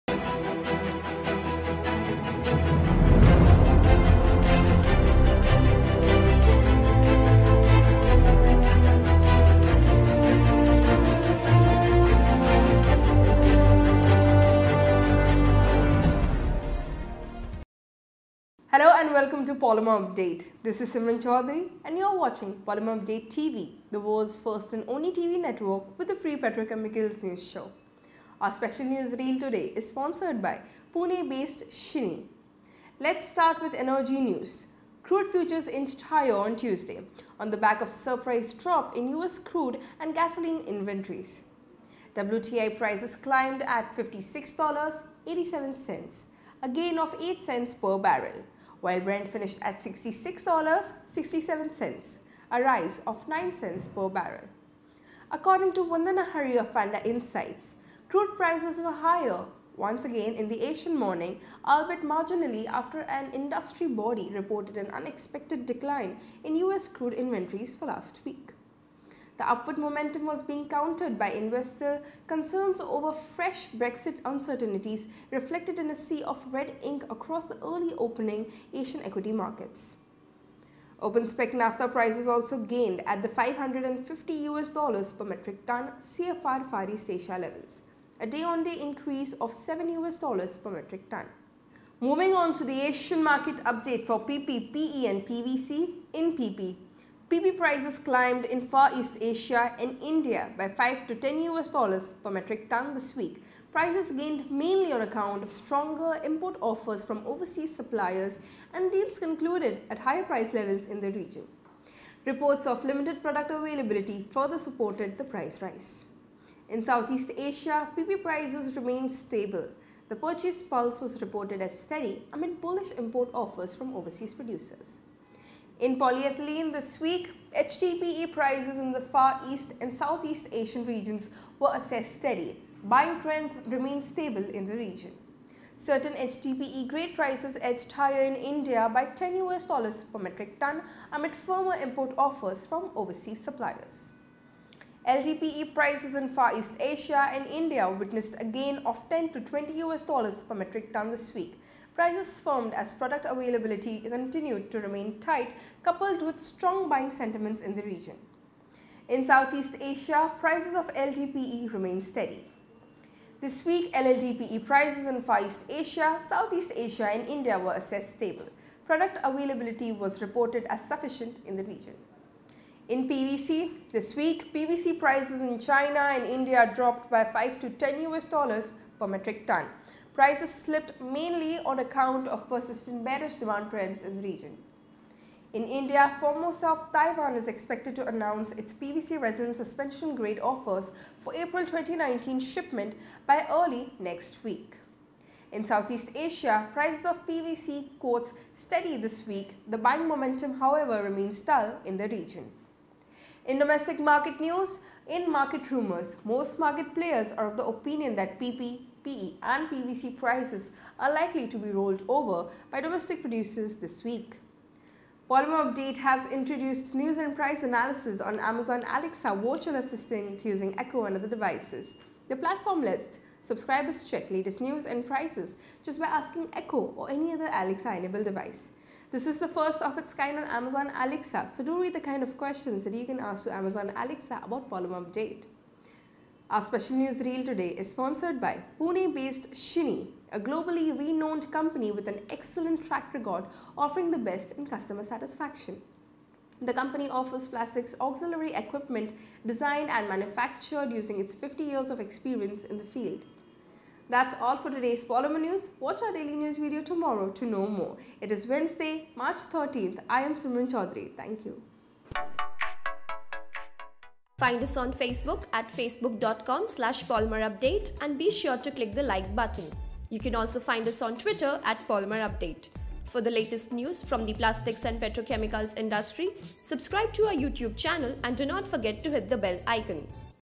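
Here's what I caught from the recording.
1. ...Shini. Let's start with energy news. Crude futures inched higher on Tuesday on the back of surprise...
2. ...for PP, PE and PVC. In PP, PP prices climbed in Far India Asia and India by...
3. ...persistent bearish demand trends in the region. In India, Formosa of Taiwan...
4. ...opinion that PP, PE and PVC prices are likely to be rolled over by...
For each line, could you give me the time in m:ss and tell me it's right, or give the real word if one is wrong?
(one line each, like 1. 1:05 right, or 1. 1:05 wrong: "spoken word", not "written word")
1. 0:31 right
2. 1:34 wrong: "East", not "India"
3. 3:02 right
4. 3:27 right.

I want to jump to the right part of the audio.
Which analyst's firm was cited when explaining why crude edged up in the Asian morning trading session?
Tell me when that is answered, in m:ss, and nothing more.
0:56.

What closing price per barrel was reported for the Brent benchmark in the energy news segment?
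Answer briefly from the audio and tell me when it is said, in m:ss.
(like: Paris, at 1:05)
$66.67, at 0:49.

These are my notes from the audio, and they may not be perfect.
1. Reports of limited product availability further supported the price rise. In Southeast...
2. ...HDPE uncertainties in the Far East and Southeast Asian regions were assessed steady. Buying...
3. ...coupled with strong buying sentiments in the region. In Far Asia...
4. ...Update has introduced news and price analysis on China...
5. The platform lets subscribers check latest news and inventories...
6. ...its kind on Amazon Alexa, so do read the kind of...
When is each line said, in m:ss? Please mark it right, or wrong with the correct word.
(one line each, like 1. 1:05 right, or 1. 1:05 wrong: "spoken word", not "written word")
1. 1:52 right
2. 2:07 wrong: "prices", not "uncertainties"
3. 2:35 wrong: "Southeast", not "Far"
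4. 3:35 wrong: "Amazon", not "China"
5. 3:42 wrong: "prices", not "inventories"
6. 3:49 right.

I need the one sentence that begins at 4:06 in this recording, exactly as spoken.
The company offers plastics auxiliary equipment designed and manufactured using its 50 years of experience in the field.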